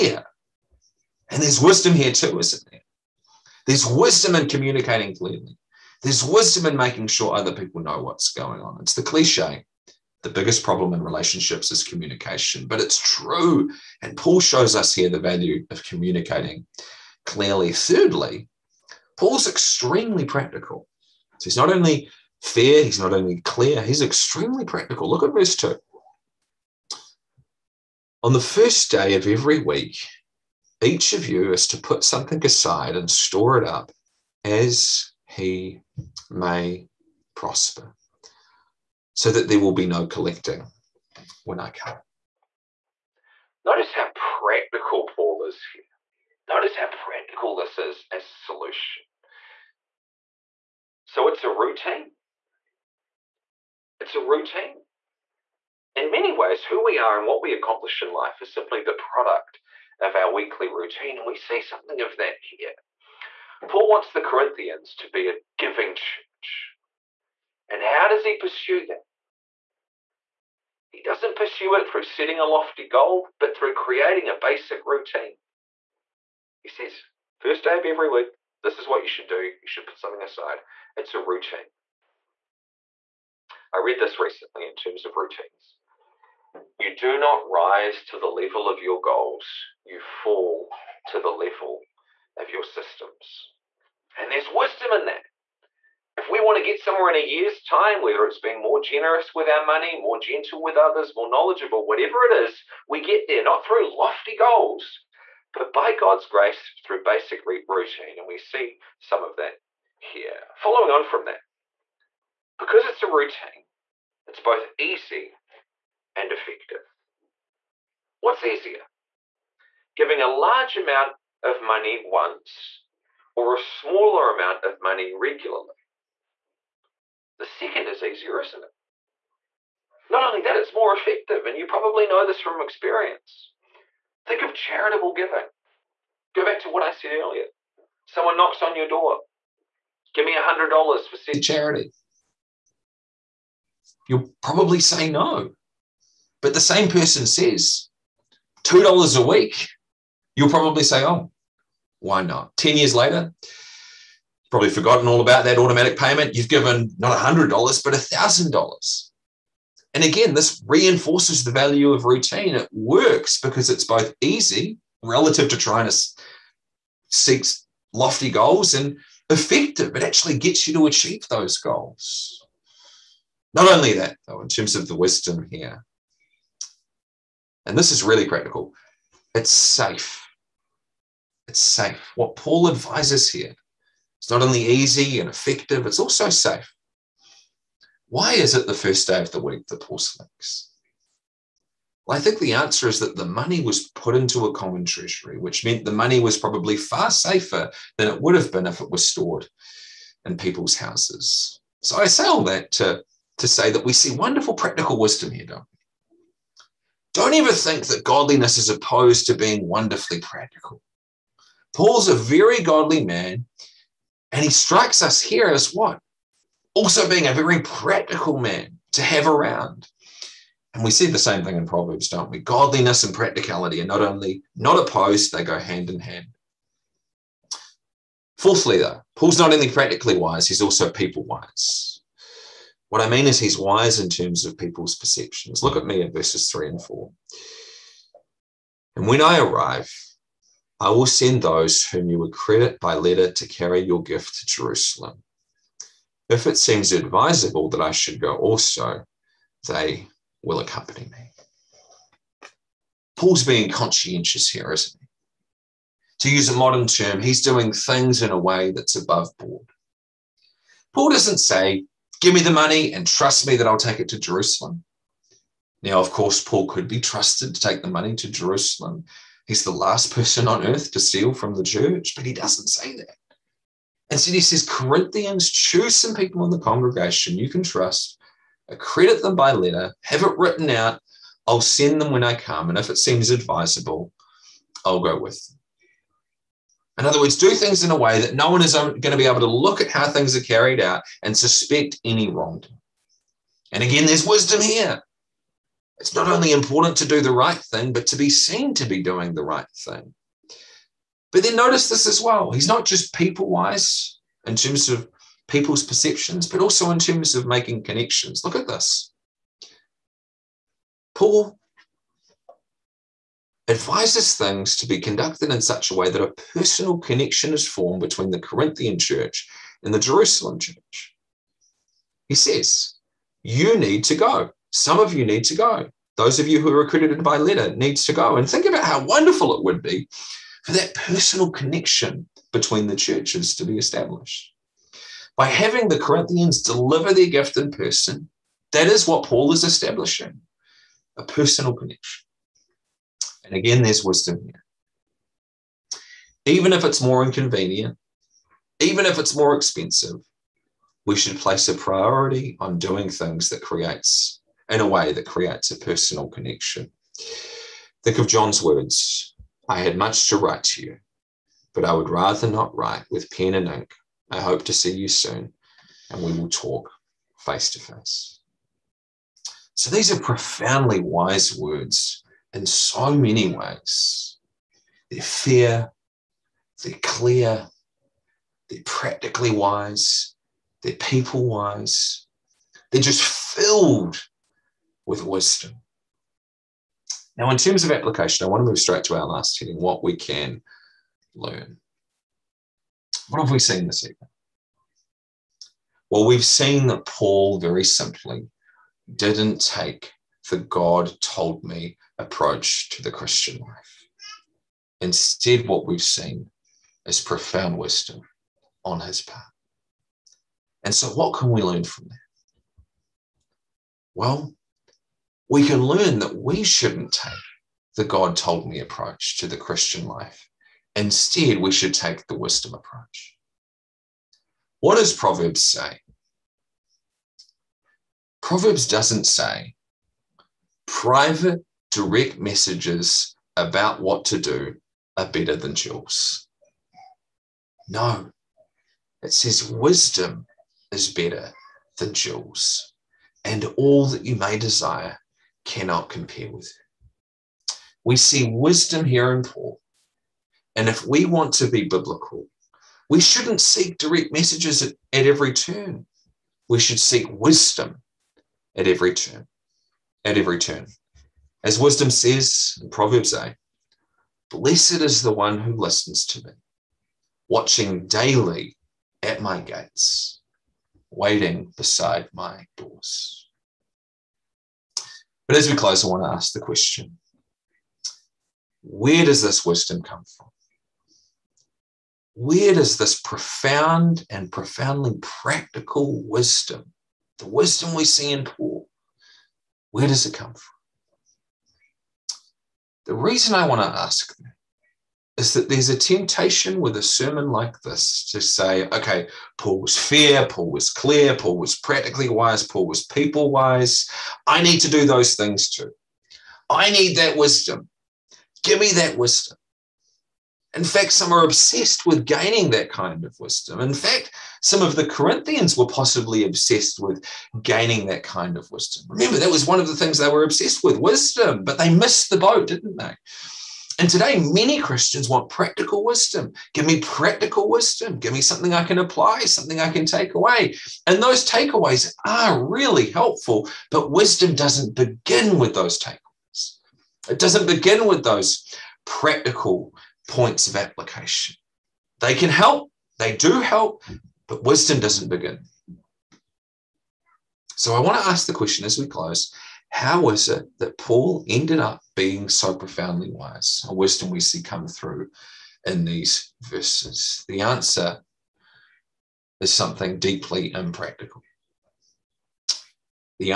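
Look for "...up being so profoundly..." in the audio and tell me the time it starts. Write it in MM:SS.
09:11.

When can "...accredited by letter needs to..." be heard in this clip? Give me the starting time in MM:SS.
05:26.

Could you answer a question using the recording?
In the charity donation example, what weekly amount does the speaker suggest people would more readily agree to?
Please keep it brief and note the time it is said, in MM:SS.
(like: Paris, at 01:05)
$2, at 02:28.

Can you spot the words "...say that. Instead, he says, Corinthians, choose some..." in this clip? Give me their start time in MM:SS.
04:32.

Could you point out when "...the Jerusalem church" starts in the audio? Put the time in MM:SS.
05:19.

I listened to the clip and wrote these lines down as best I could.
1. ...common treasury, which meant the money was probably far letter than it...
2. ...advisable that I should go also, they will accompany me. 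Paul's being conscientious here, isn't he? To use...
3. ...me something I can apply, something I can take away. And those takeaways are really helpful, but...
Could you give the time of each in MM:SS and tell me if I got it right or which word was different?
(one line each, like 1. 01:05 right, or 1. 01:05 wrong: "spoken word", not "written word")
1. 03:14 wrong: "safer", not "letter"
2. 04:06 right
3. 08:48 right.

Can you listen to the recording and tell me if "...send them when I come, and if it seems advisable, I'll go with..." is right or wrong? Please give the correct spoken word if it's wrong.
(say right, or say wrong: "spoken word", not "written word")
right.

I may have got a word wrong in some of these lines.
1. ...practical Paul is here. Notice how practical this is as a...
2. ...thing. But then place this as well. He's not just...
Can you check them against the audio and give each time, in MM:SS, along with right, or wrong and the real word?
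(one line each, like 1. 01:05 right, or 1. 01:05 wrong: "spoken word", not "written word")
1. 00:44 right
2. 04:59 wrong: "notice", not "place".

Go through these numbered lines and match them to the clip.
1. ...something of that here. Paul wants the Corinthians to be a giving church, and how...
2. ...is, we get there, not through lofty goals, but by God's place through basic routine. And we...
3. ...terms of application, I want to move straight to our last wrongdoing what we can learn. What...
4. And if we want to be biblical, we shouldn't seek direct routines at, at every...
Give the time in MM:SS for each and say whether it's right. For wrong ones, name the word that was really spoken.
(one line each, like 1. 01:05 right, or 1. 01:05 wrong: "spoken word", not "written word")
1. 01:01 right
2. 01:42 wrong: "grace", not "place"
3. 06:27 wrong: "heading", not "wrongdoing"
4. 07:30 wrong: "messages", not "routines".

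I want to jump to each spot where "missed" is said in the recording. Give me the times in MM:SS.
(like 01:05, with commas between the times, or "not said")
08:41.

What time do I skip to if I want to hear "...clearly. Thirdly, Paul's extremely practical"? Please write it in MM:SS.
00:17.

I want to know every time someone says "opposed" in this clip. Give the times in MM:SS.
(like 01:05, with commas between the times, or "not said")
03:28, 03:44.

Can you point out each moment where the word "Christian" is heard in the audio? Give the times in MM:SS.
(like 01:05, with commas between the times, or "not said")
06:43, 06:59, 08:44.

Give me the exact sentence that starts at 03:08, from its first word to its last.
Why is it the first day of the week that Paul selects?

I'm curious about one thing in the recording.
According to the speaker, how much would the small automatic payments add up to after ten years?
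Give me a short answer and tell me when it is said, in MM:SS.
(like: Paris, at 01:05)
$1,000, at 02:37.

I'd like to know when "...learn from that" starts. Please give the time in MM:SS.
06:51.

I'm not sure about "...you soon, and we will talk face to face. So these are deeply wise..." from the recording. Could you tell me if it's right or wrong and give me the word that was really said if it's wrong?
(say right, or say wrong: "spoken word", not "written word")
wrong: "profoundly", not "deeply".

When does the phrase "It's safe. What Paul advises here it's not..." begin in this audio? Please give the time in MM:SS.
03:01.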